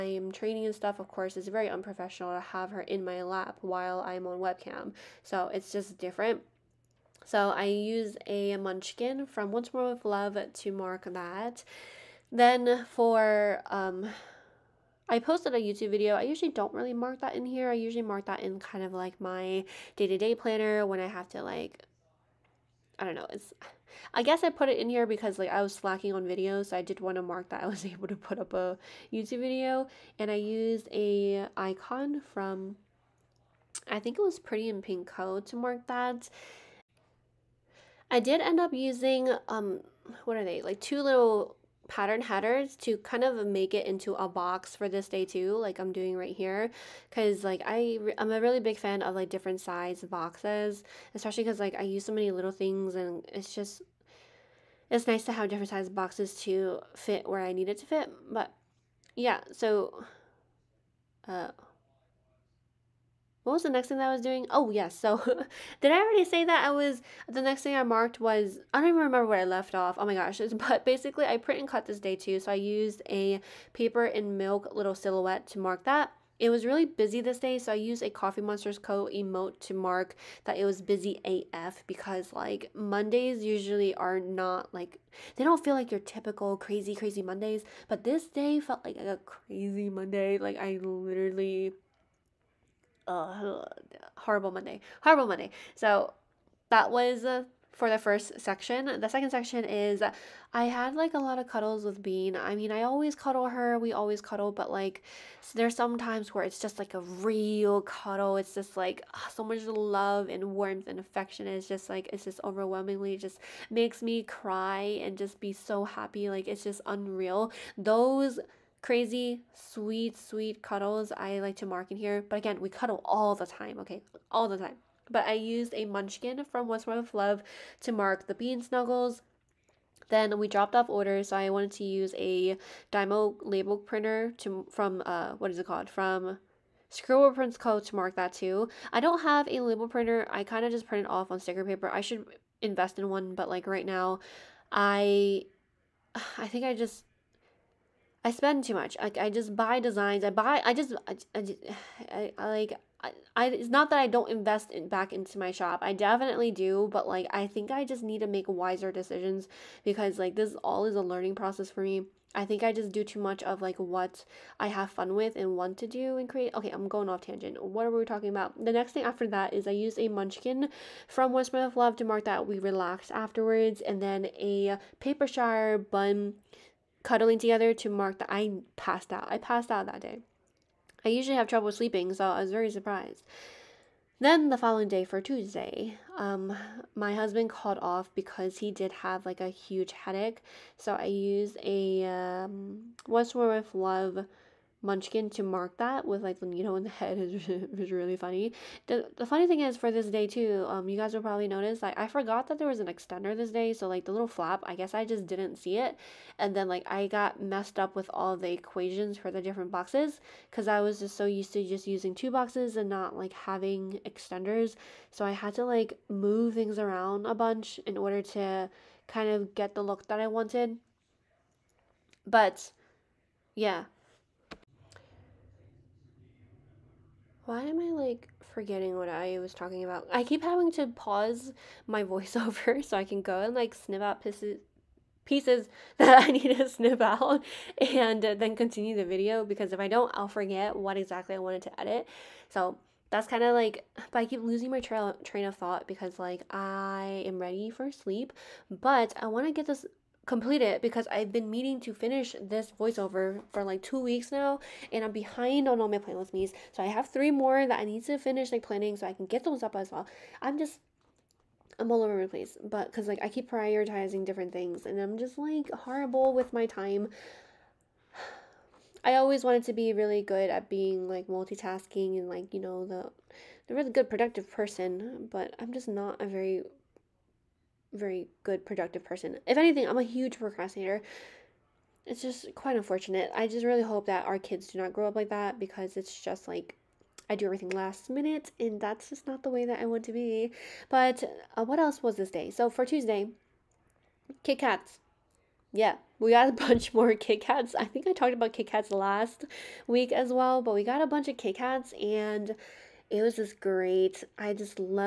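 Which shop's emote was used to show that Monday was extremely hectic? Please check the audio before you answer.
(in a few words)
Coffee Monsters Co.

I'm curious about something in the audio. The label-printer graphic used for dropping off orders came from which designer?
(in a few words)
Scribble Prints Co.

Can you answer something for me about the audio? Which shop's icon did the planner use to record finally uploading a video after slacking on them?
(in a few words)
Pretty in Pink Co.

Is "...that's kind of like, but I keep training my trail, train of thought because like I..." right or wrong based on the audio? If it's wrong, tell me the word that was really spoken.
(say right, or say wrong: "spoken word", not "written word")
wrong: "losing", not "training".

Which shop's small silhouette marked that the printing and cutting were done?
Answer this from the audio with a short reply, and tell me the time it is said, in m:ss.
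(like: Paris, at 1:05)
Paper and Milk, at 1:13.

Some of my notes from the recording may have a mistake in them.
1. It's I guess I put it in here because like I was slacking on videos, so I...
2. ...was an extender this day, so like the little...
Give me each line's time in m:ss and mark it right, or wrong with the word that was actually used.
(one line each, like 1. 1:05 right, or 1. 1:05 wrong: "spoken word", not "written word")
1. 0:23 right
2. 3:22 right.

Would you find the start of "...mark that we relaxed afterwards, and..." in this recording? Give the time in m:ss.
2:52.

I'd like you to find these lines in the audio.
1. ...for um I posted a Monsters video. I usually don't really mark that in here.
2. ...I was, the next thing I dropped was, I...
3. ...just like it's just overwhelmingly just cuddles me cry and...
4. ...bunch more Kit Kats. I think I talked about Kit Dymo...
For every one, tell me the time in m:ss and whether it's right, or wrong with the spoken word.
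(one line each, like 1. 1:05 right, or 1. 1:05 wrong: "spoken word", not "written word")
1. 0:12 wrong: "YouTube", not "Monsters"
2. 1:06 wrong: "marked", not "dropped"
3. 1:51 wrong: "makes", not "cuddles"
4. 4:56 wrong: "Kats", not "Dymo".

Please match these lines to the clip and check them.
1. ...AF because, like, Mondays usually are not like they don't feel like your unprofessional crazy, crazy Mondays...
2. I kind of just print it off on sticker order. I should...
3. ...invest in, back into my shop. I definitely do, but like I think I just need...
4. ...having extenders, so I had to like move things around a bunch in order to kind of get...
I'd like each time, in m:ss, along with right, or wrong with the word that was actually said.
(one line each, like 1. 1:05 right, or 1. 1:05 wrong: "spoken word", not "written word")
1. 1:21 wrong: "typical", not "unprofessional"
2. 2:20 wrong: "paper", not "order"
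3. 2:34 right
4. 3:33 right.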